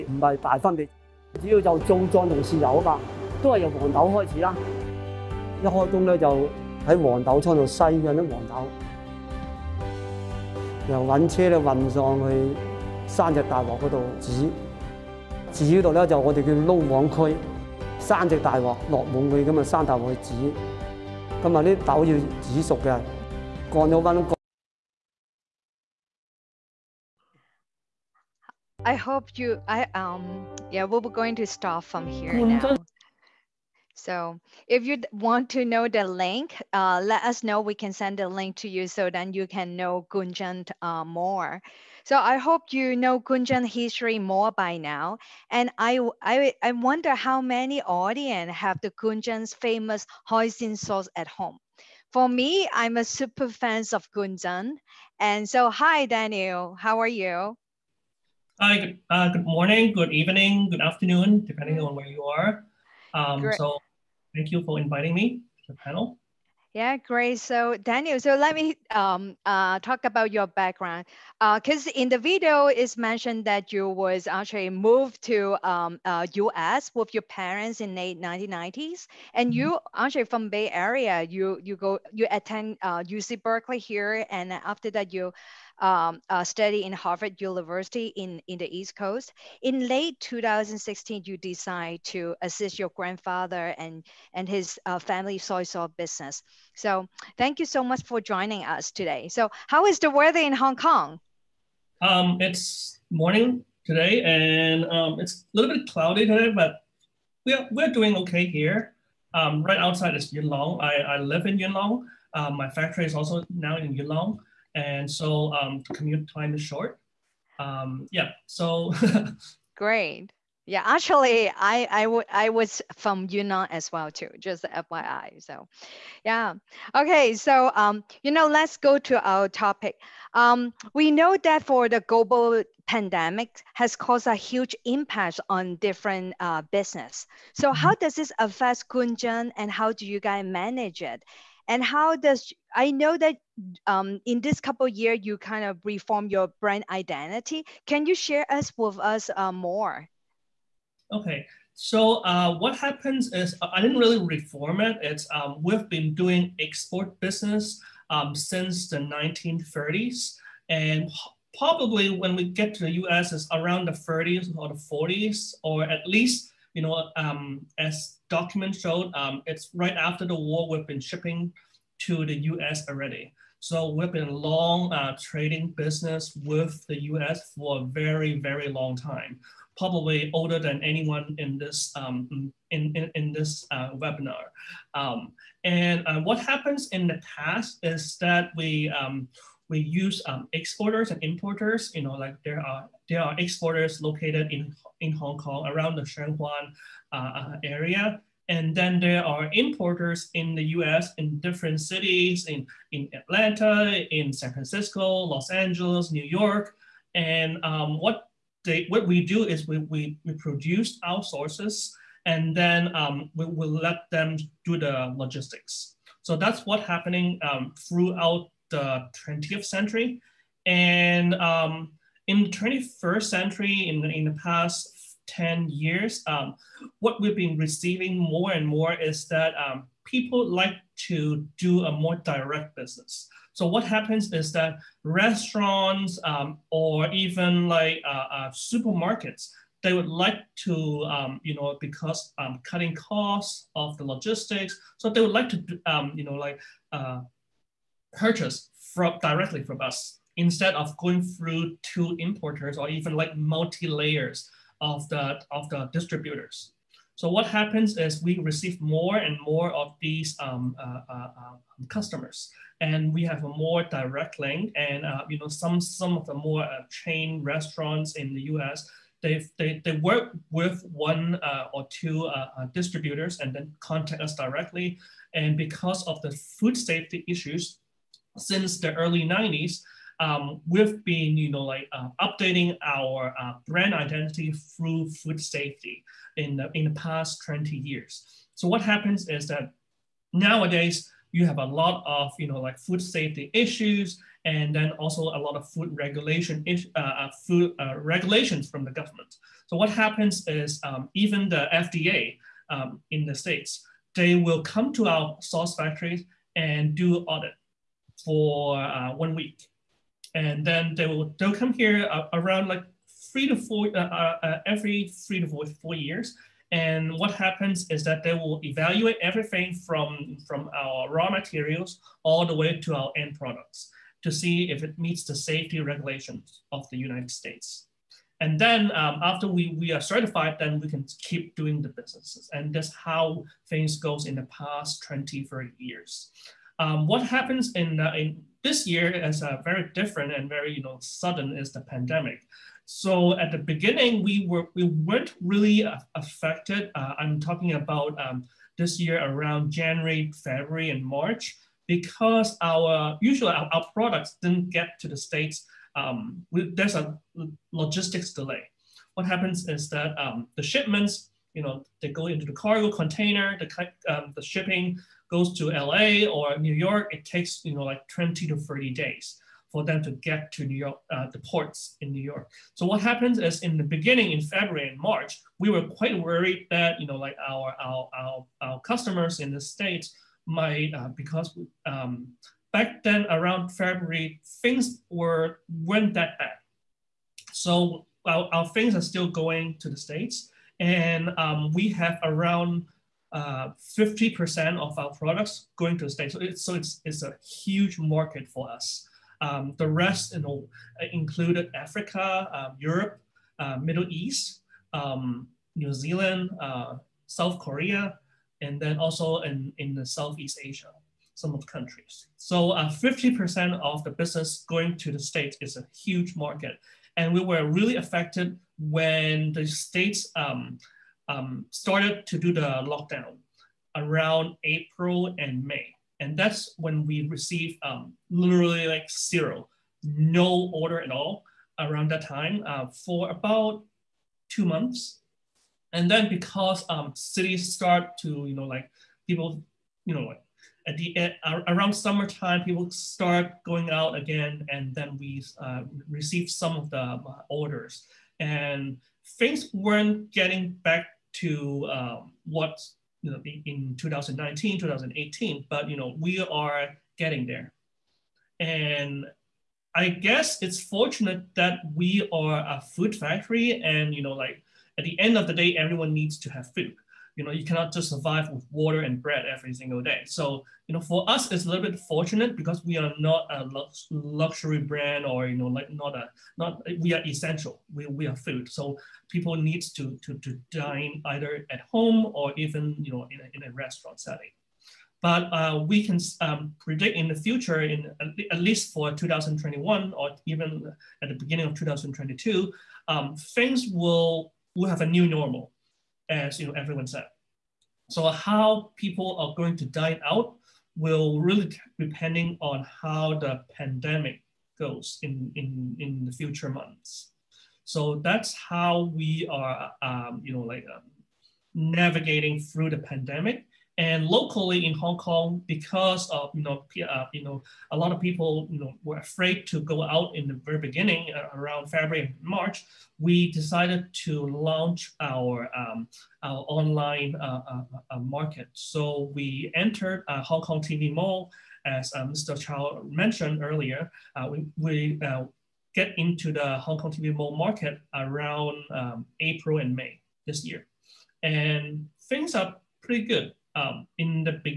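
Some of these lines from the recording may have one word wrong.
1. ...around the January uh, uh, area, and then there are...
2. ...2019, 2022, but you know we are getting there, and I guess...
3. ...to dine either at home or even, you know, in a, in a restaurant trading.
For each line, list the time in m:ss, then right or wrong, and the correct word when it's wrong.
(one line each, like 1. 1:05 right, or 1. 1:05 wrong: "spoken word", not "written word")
1. 3:15 wrong: "Shenzhen", not "January"
2. 7:33 wrong: "2018", not "2022"
3. 8:00 wrong: "setting", not "trading".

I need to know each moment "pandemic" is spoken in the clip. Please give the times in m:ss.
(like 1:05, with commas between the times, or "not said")
2:12, 5:41, 8:23, 8:32.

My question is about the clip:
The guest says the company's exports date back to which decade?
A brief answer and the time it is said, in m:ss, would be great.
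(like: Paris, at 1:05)
1930s, at 2:38.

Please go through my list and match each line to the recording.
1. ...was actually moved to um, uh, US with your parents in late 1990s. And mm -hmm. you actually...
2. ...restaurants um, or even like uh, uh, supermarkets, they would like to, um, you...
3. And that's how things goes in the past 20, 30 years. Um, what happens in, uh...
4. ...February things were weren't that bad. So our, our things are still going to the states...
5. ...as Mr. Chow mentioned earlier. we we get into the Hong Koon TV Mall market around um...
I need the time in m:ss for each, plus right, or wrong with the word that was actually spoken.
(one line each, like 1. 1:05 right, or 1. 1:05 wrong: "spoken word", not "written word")
1. 1:13 right
2. 3:55 right
3. 5:32 right
4. 6:23 right
5. 8:51 wrong: "Kong", not "Koon".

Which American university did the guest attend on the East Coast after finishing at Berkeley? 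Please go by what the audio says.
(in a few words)
Harvard University.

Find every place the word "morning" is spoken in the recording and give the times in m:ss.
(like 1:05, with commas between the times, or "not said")
0:59, 1:43.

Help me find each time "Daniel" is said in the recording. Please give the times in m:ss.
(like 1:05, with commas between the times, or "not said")
0:56, 1:07.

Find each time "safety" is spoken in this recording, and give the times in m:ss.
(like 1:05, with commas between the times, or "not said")
4:36, 4:45, 4:53, 5:25.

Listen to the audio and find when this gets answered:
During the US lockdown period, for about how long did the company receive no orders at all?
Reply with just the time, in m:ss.
7:13.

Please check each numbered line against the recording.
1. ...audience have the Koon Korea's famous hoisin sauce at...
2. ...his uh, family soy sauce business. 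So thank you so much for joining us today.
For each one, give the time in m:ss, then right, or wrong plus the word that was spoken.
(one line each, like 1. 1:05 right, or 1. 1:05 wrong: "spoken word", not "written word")
1. 0:47 wrong: "Chun", not "Korea"
2. 1:34 right.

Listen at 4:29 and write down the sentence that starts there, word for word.
They, they, they work with one uh, or two distributors and then contact us directly.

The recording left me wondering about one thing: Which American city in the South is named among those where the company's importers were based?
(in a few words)
Atlanta.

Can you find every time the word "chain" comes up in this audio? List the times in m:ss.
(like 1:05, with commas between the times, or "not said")
4:26.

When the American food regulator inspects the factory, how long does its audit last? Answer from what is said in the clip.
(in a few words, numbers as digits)
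one week.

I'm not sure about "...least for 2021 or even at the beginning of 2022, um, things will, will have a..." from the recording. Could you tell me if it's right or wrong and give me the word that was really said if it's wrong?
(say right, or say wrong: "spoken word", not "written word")
right.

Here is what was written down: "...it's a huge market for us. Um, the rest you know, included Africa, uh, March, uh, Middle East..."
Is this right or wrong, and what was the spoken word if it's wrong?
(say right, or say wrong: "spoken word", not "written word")
wrong: "Europe", not "March".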